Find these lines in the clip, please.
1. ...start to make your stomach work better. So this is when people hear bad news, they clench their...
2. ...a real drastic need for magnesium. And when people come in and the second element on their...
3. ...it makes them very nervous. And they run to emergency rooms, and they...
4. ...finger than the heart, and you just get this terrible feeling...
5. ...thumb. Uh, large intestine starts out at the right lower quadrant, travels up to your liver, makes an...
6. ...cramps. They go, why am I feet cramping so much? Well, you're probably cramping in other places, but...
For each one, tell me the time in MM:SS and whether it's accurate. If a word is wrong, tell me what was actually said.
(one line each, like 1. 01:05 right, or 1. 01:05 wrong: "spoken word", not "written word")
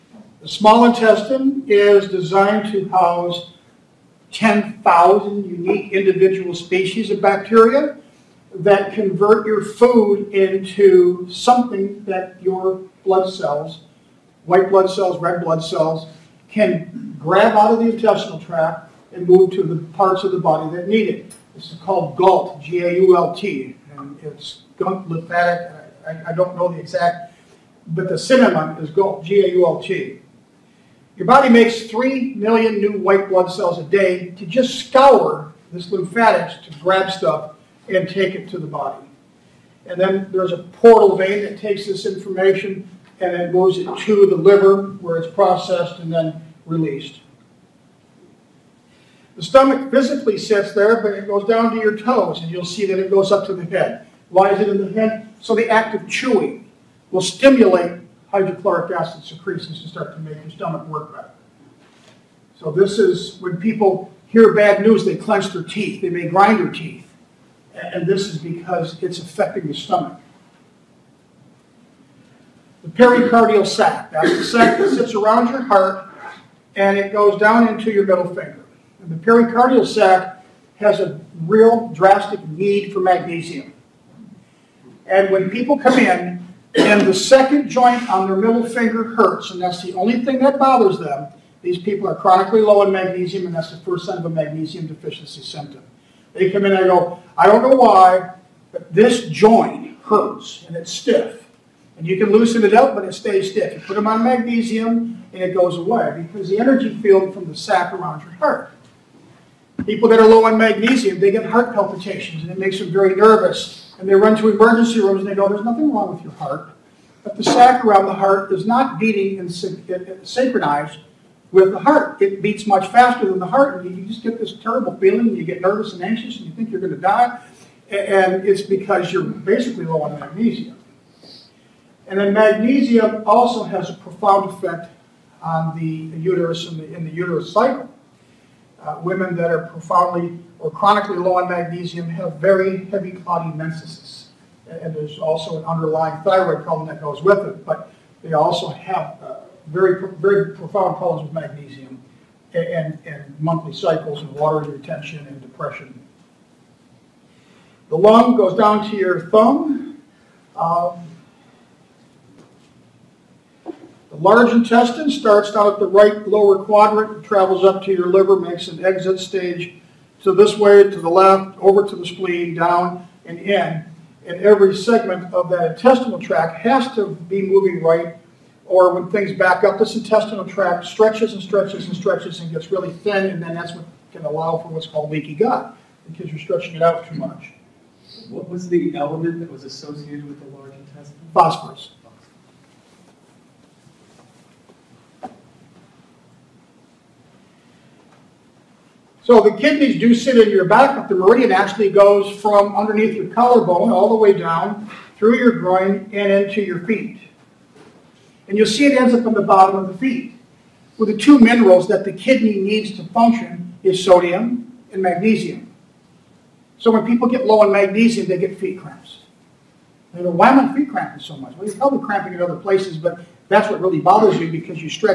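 1. 00:59 right
2. 01:21 wrong: "joint", not "element"
3. 01:52 right
4. 02:02 wrong: "faster", not "finger"
5. 02:39 right
6. 03:38 right.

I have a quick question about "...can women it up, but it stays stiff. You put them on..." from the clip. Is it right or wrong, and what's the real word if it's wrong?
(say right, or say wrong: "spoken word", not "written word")
wrong: "loosen", not "women".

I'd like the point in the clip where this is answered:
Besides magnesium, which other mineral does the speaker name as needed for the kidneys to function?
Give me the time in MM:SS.
03:34.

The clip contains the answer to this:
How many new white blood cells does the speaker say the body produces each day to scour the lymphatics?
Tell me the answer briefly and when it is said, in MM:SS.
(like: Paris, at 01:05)
3 million, at 00:31.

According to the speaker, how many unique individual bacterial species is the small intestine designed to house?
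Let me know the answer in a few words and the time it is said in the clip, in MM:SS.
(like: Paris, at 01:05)
10,000, at 00:04.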